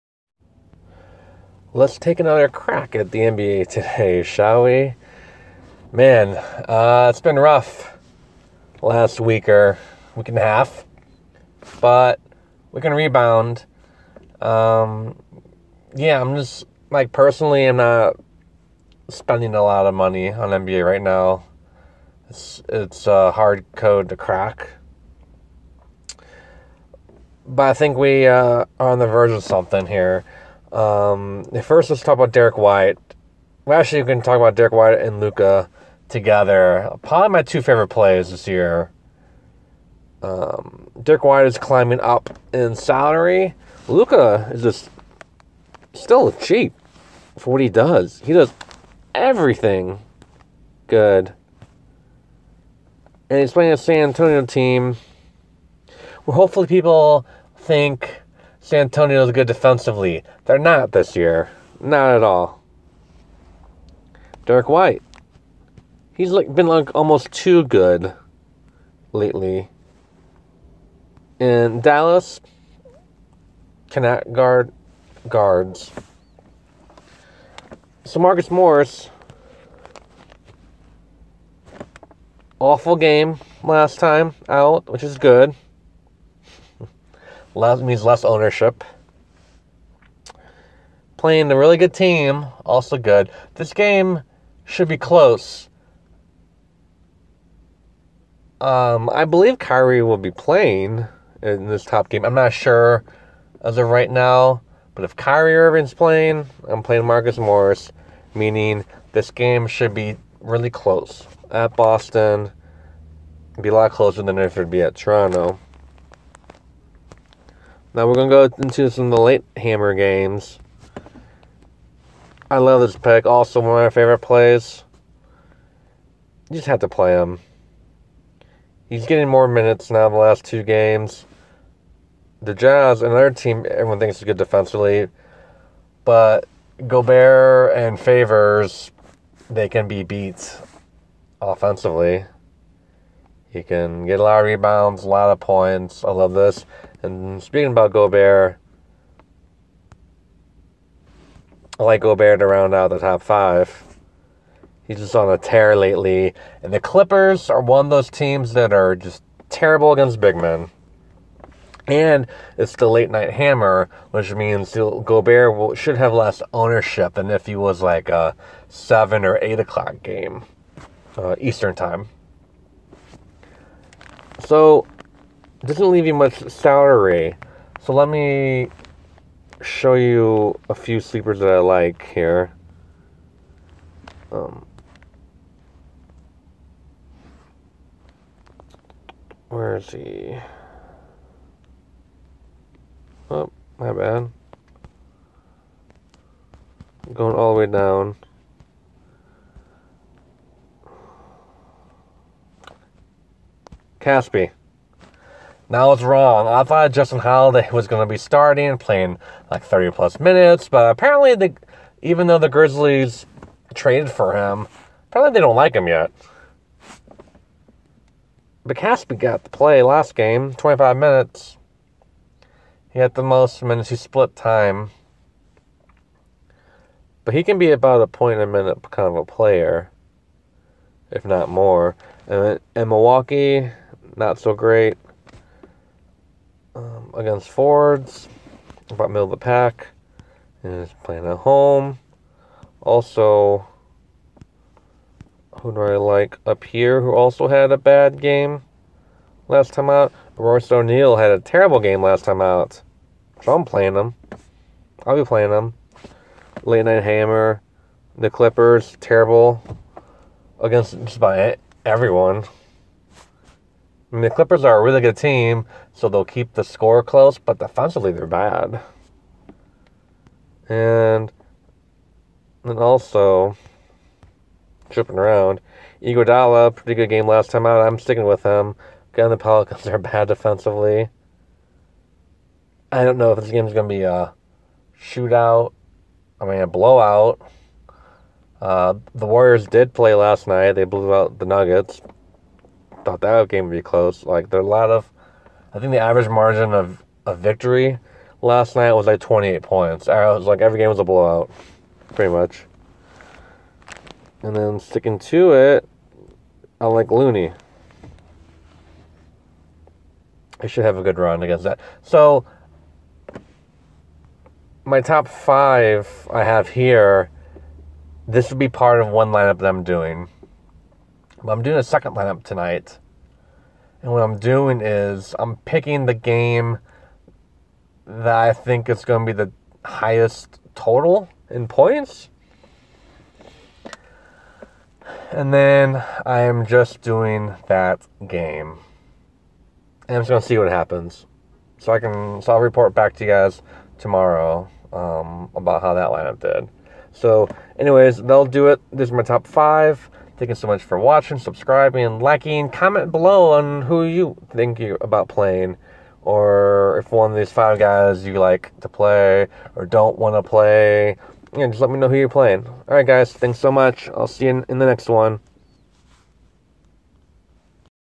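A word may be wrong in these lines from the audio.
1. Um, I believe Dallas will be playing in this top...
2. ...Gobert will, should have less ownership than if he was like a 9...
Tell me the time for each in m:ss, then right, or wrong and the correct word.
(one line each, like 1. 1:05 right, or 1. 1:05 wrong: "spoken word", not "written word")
1. 1:38 wrong: "Kyrie", not "Dallas"
2. 2:44 wrong: "7", not "9".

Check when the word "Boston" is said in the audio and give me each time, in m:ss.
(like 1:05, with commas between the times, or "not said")
1:51.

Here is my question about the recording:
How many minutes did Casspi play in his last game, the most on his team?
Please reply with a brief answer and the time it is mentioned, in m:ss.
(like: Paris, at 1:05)
25, at 3:40.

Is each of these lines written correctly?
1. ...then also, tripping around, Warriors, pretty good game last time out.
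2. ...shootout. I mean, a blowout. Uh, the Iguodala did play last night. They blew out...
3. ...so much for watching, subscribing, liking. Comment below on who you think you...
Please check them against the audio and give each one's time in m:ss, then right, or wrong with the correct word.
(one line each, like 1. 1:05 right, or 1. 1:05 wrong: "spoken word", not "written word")
1. 4:32 wrong: "Iguodala", not "Warriors"
2. 4:45 wrong: "Warriors", not "Iguodala"
3. 5:50 right.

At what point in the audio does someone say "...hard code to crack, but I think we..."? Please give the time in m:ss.
0:23.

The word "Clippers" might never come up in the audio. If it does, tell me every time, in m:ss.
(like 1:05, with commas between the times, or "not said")
2:36, 4:18, 4:24.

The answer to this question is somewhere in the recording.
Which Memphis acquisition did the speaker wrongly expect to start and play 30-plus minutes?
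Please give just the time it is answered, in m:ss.
3:26.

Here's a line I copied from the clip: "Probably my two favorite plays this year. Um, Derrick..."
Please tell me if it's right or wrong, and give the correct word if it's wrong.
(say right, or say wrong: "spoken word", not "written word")
right.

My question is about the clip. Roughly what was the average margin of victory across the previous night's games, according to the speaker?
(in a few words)
28 points.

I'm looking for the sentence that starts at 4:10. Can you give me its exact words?
Royce O'Neale had a terrible game last time out.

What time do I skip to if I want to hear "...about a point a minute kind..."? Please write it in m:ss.
3:47.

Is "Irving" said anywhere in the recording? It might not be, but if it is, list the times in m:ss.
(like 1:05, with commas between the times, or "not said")
1:45.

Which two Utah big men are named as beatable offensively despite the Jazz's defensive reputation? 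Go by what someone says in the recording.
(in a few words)
Gobert and Favors.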